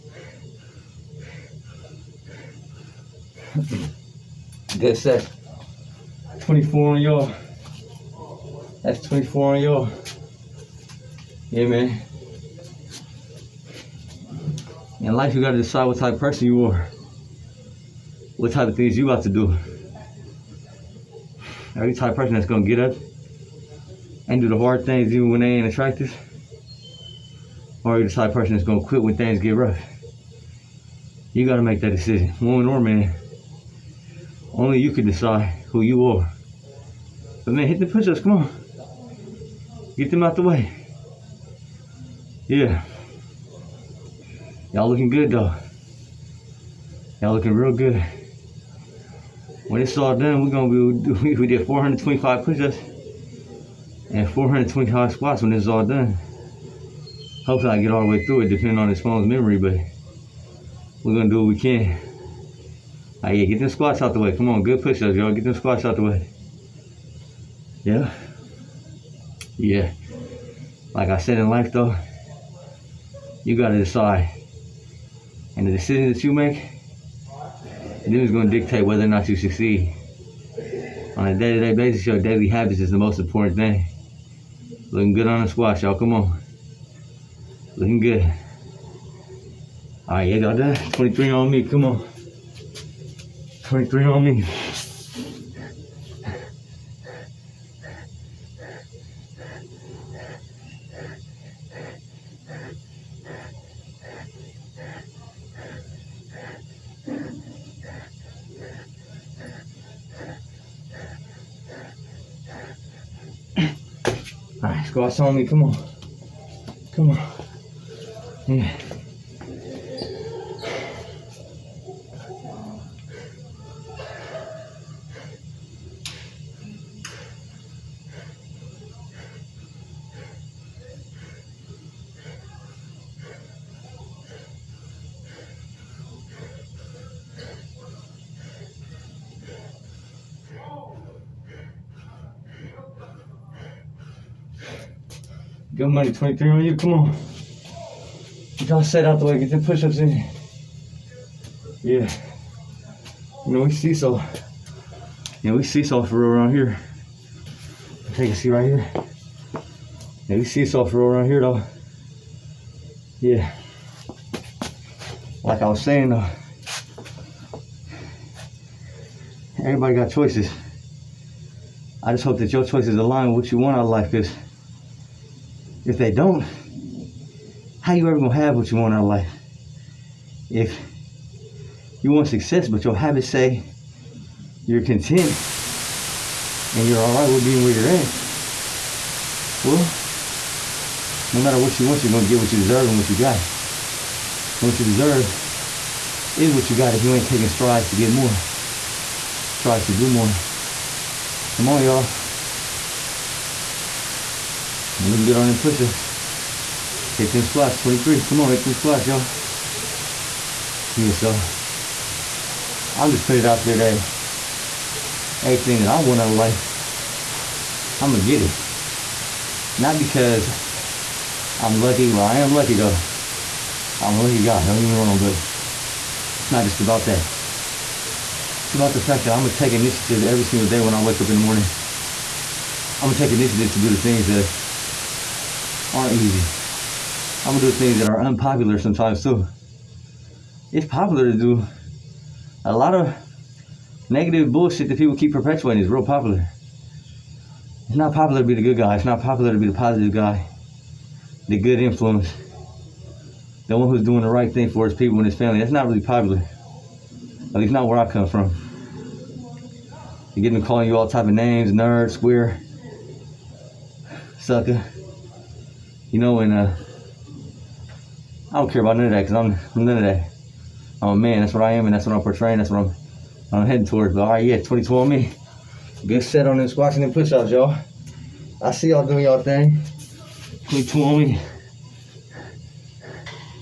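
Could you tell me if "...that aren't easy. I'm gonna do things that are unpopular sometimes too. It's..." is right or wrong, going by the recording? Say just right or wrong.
right.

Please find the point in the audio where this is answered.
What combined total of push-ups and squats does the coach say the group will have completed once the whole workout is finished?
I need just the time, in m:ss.
0:51.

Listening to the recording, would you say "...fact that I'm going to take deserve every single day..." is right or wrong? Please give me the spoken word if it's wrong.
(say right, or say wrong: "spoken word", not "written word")
wrong: "initiative", not "deserve".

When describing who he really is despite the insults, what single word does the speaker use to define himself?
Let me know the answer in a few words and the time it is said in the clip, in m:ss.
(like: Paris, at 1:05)
a man, at 4:31.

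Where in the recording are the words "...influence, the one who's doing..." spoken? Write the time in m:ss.
4:11.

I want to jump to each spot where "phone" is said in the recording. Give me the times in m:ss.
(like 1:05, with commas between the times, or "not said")
0:59.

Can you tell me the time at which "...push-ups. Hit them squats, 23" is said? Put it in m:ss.
3:25.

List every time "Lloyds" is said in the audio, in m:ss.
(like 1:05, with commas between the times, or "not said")
not said.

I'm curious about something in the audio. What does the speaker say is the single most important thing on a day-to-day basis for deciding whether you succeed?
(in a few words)
daily habits.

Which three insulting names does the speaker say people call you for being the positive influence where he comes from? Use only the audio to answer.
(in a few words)
nerd, square, sucker.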